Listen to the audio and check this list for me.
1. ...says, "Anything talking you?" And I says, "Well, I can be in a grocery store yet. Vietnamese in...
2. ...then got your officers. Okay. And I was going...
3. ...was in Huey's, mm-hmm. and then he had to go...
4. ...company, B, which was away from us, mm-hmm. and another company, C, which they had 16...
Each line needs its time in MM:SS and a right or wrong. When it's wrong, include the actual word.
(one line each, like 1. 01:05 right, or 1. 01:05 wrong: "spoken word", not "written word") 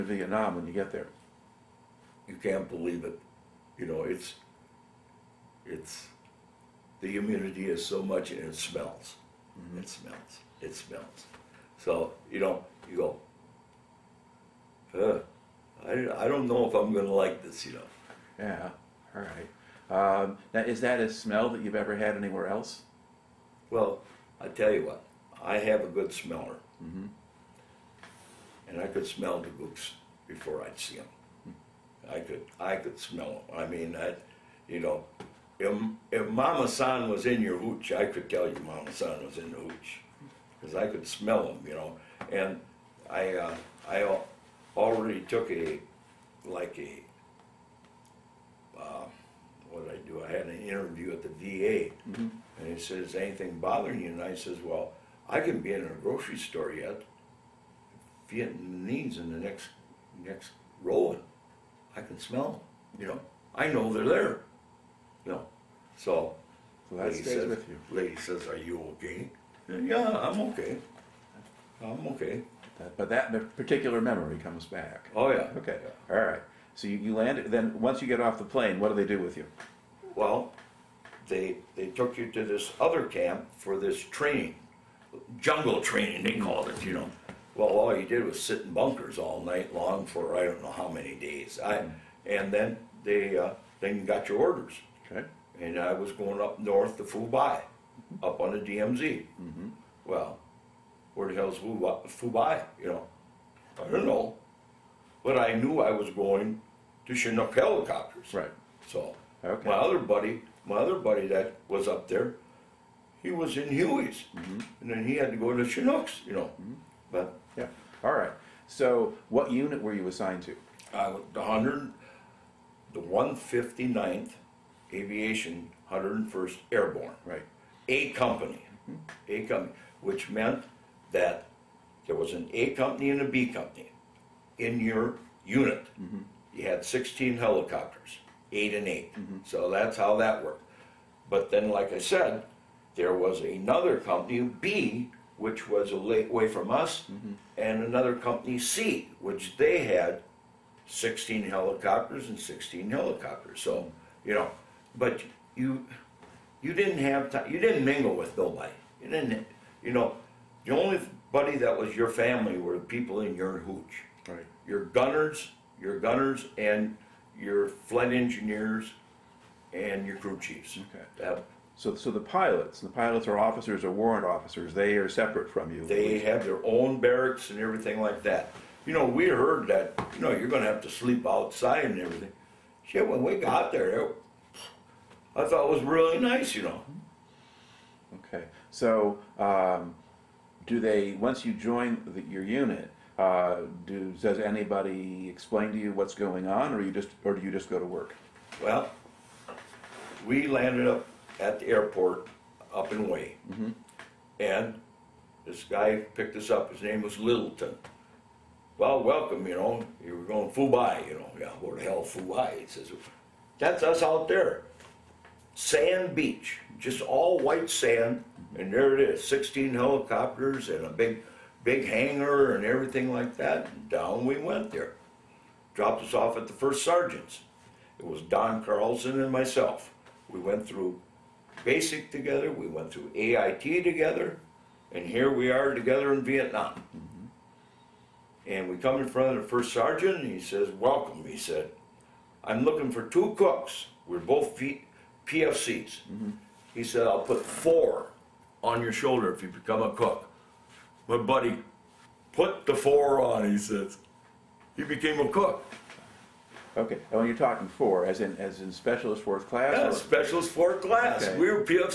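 1. 00:52 wrong: "bothering", not "talking"
2. 01:33 wrong: "orders", not "officers"
3. 01:53 right
4. 02:24 right.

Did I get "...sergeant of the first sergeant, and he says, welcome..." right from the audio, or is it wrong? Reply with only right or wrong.
wrong.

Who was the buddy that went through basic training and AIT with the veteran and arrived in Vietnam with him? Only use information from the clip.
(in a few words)
Don Carlson.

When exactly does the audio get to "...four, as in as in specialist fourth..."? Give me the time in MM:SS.
04:17.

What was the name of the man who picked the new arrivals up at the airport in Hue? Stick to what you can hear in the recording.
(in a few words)
Littleton.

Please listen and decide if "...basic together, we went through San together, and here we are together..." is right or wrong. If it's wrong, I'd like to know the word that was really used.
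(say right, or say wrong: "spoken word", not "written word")
wrong: "AIT", not "San".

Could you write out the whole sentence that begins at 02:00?
I the hundred, the one fifty ninth Aviation 101st Airborne.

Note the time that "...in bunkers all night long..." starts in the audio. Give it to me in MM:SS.
01:28.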